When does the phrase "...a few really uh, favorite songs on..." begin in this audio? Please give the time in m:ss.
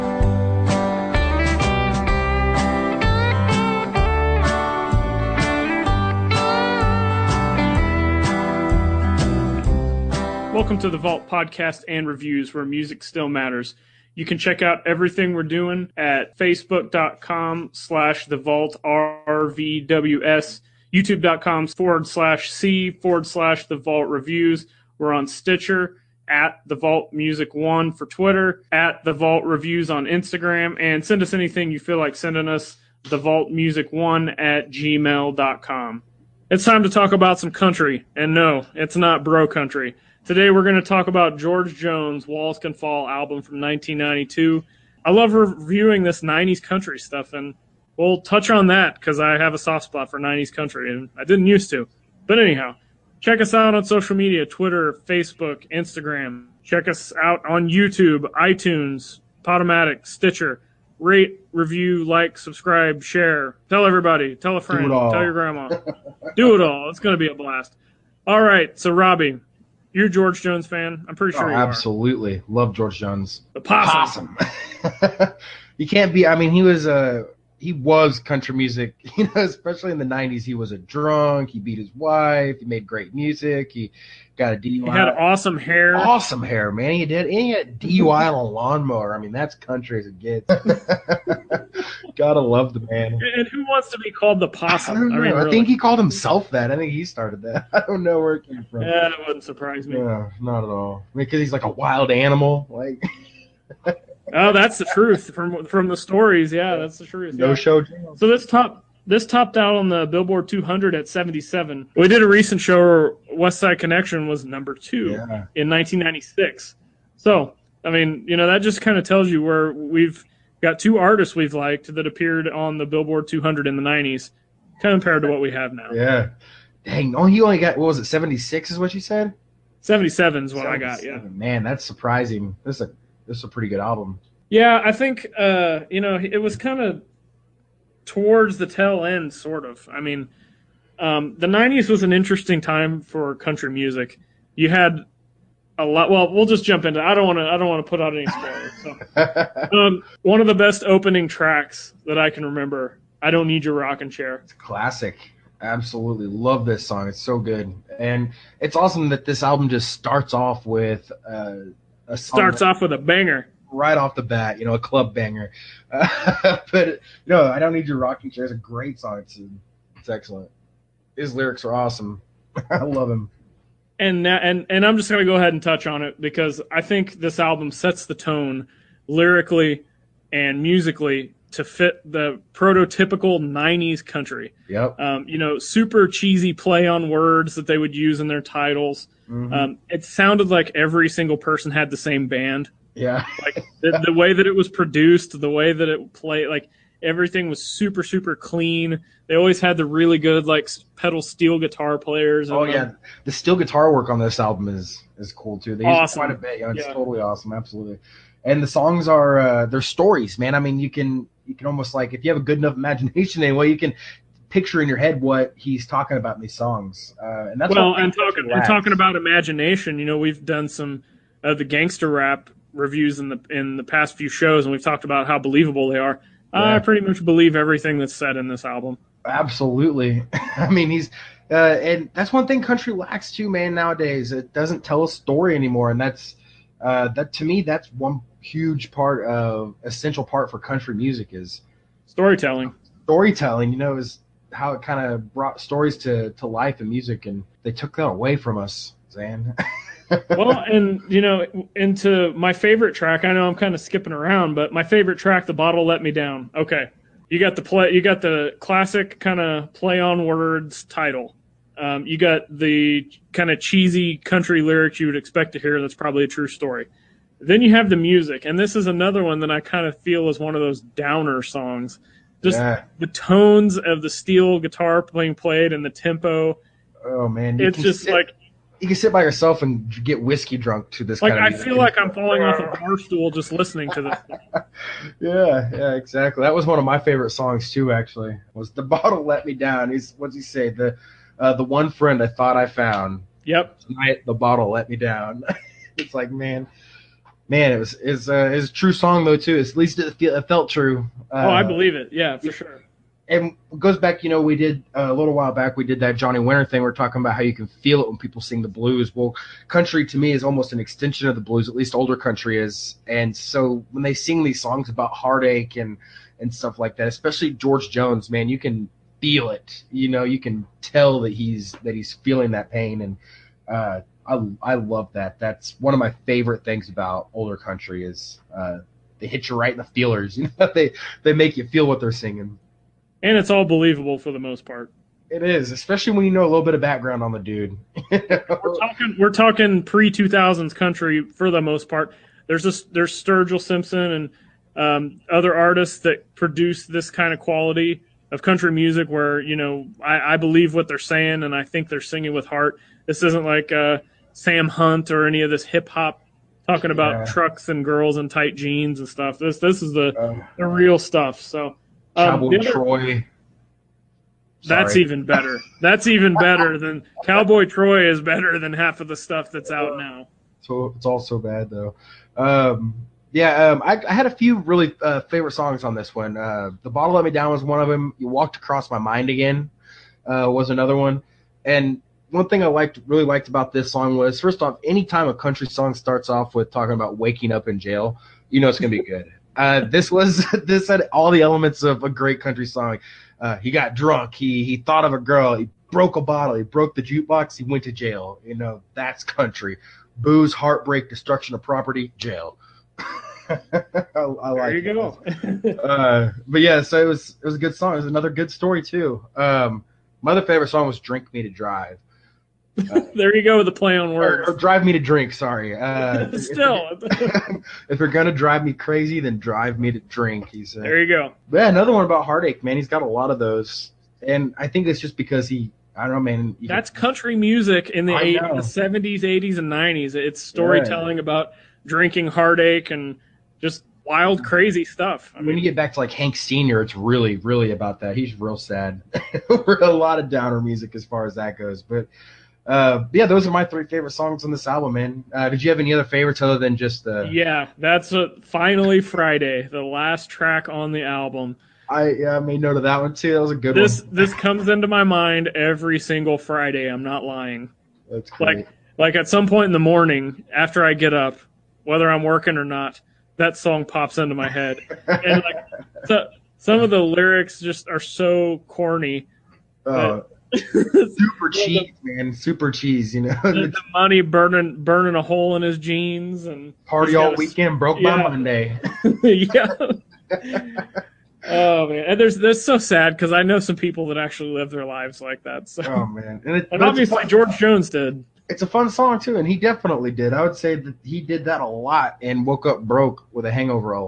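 6:14.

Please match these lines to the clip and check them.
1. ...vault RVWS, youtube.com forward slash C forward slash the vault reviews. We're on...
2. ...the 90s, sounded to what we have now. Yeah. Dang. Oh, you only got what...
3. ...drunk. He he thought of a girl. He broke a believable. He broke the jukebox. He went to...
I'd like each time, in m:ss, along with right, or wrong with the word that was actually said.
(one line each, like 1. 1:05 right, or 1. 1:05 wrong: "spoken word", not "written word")
1. 0:18 right
2. 2:03 wrong: "compared", not "sounded"
3. 6:33 wrong: "bottle", not "believable".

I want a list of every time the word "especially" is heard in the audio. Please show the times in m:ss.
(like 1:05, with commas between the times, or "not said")
1:19, 5:17, 5:35.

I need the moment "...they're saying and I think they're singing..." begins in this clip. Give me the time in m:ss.
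5:50.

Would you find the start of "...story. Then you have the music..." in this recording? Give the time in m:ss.
4:26.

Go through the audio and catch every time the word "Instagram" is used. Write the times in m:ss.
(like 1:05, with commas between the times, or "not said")
0:30, 0:55.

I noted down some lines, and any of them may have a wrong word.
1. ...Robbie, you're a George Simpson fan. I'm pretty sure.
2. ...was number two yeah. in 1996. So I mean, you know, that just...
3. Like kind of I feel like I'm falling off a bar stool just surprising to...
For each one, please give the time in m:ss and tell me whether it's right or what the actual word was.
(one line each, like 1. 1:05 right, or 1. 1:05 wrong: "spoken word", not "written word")
1. 1:08 wrong: "Jones", not "Simpson"
2. 1:54 right
3. 4:41 wrong: "listening", not "surprising".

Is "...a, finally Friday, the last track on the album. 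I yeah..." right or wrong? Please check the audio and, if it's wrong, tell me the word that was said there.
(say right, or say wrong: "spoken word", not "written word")
right.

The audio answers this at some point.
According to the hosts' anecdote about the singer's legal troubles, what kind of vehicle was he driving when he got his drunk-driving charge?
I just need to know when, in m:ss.
1:28.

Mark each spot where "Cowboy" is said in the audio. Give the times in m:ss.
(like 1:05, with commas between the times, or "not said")
6:02, 6:07.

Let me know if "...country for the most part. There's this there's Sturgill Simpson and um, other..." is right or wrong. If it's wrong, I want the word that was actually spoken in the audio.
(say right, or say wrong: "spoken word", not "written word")
right.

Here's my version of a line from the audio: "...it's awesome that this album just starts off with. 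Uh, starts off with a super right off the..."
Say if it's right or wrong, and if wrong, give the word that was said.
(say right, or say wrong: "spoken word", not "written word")
wrong: "banger", not "super".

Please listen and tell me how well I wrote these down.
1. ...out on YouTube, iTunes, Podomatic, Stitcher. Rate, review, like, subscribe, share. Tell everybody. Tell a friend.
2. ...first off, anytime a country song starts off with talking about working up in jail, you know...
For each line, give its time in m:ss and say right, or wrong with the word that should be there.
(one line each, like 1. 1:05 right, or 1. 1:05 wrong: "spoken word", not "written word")
1. 0:57 right
2. 6:24 wrong: "waking", not "working".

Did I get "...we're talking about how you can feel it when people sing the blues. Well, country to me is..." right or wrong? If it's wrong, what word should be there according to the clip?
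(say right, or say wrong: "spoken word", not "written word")
right.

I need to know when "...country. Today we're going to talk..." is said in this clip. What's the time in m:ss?
0:39.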